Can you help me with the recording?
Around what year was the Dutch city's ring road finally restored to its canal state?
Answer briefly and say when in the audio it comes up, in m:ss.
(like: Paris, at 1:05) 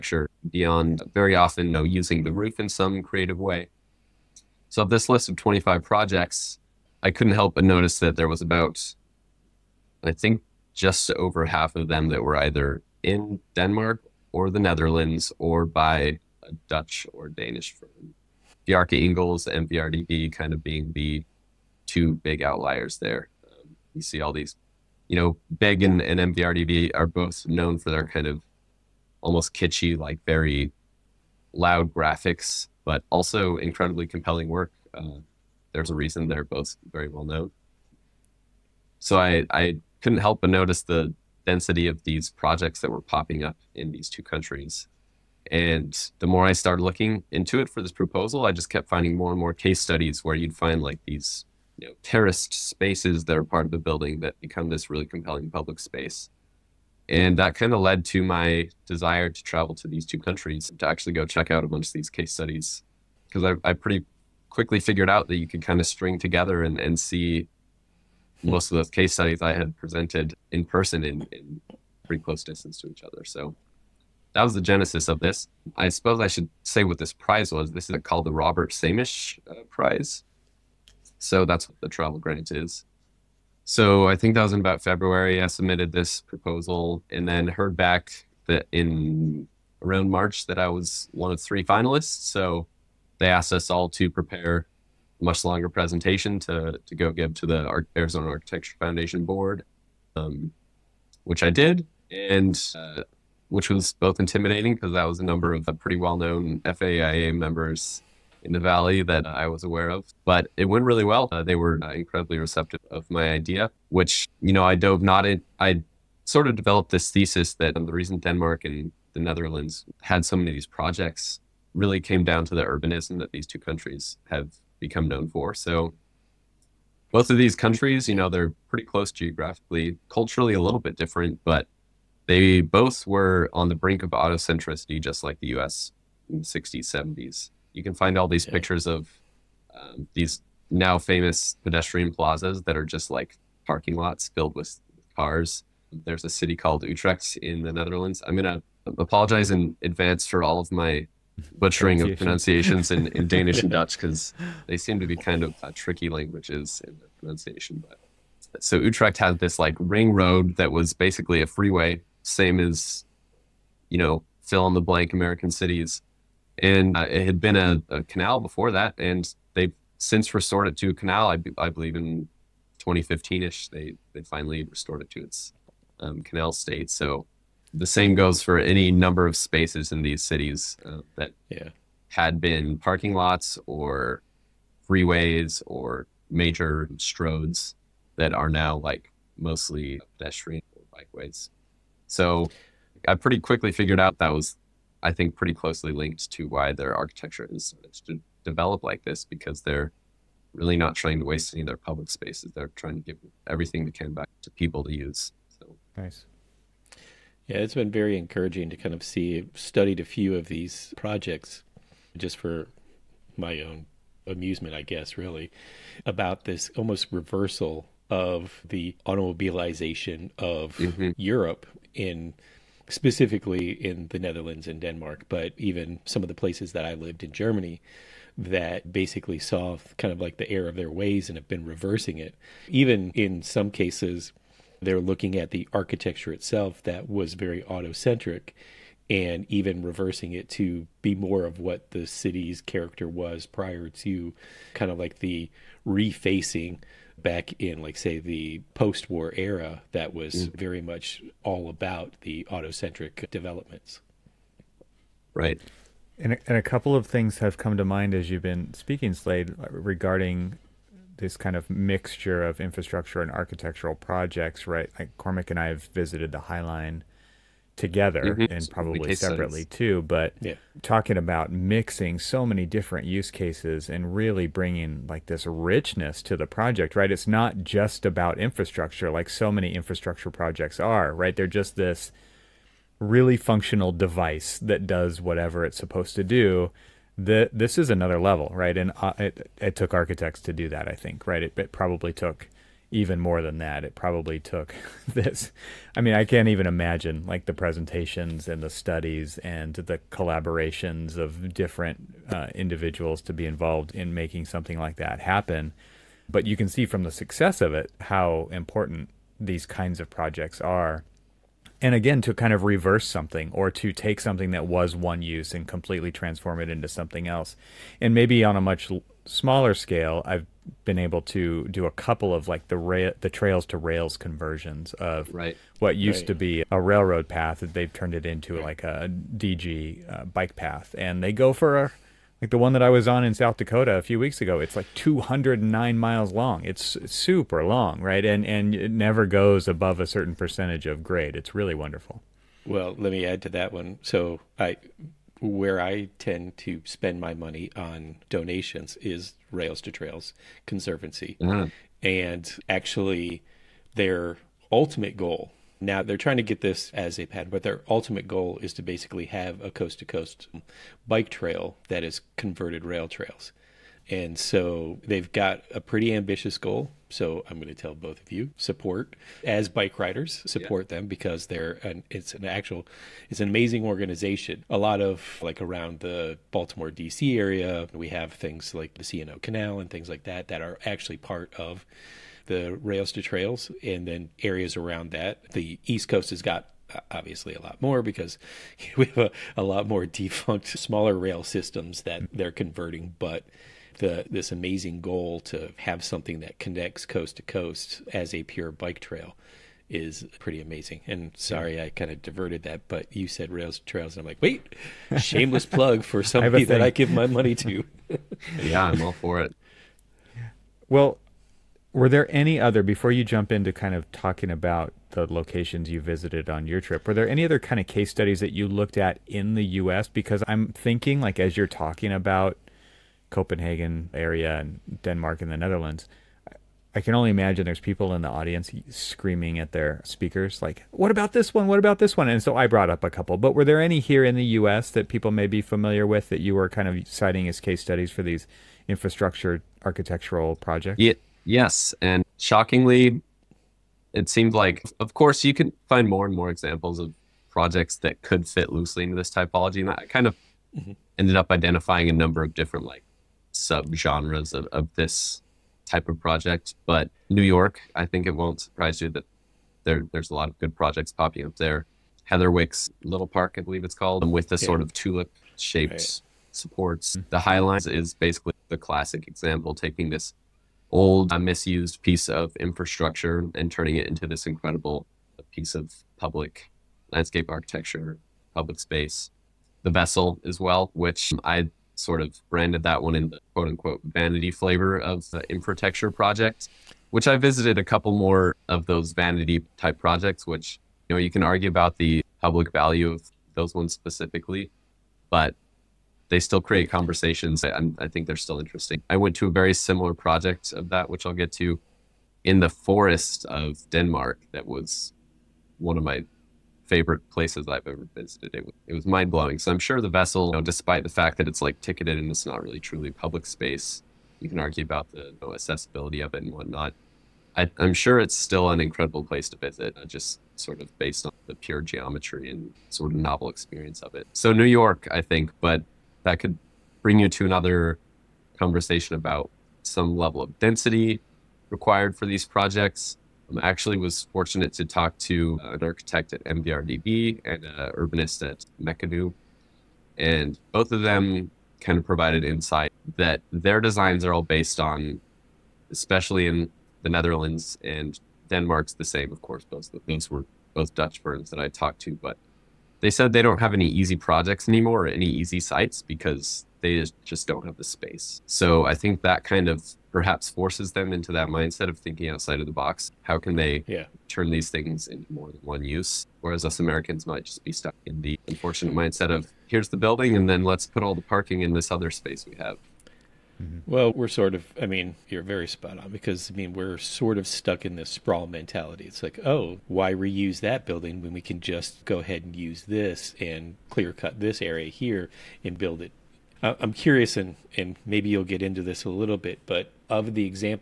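2015, at 2:52.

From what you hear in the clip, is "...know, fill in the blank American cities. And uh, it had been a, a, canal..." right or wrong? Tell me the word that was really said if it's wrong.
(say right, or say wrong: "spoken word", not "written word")
right.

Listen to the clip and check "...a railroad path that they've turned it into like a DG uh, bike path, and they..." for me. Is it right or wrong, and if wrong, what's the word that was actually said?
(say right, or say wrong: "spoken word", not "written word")
right.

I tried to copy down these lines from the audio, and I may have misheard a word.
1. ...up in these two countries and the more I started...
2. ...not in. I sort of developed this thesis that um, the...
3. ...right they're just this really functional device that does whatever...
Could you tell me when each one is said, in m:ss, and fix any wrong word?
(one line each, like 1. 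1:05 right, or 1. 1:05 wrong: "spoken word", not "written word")
1. 0:43 right
2. 1:55 right
3. 4:41 right.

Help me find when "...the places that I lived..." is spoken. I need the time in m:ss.
3:46.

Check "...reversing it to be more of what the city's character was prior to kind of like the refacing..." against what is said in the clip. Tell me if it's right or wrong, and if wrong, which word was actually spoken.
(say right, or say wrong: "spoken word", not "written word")
right.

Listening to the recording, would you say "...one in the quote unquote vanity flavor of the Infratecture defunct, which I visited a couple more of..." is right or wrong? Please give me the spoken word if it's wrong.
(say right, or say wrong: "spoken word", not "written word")
wrong: "project", not "defunct".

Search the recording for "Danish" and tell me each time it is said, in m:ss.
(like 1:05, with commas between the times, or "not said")
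0:17, 2:33.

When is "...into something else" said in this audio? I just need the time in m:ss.
5:16.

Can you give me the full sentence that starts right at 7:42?
Heatherwick's Little Park, I believe it's called, with the sort of tulip shaped right.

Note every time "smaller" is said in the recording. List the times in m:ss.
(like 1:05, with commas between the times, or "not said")
5:19, 6:30.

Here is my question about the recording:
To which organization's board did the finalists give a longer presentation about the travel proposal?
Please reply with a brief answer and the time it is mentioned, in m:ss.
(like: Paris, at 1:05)
Arizona Architecture Foundation, at 1:37.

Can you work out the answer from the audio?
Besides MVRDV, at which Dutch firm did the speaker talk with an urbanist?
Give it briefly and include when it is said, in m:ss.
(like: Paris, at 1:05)
Mecanoo, at 8:58.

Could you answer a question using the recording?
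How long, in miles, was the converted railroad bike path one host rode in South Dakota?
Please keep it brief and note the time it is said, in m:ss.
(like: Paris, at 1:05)
209 miles, at 5:34.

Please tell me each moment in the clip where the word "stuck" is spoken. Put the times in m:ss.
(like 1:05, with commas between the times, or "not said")
9:27, 9:37.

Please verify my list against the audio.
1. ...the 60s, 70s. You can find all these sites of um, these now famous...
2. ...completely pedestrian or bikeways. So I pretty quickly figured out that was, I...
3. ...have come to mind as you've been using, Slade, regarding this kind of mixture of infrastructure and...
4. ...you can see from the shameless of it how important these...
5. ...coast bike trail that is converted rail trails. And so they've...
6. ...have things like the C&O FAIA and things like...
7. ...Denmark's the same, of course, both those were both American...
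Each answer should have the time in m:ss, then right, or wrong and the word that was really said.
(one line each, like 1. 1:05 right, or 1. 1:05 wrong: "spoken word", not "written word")
1. 2:16 wrong: "pictures", not "sites"
2. 3:09 wrong: "mostly", not "completely"
3. 4:17 wrong: "speaking", not "using"
4. 5:06 wrong: "success", not "shameless"
5. 6:00 right
6. 6:18 wrong: "Canal", not "FAIA"
7. 9:08 wrong: "Dutch", not "American".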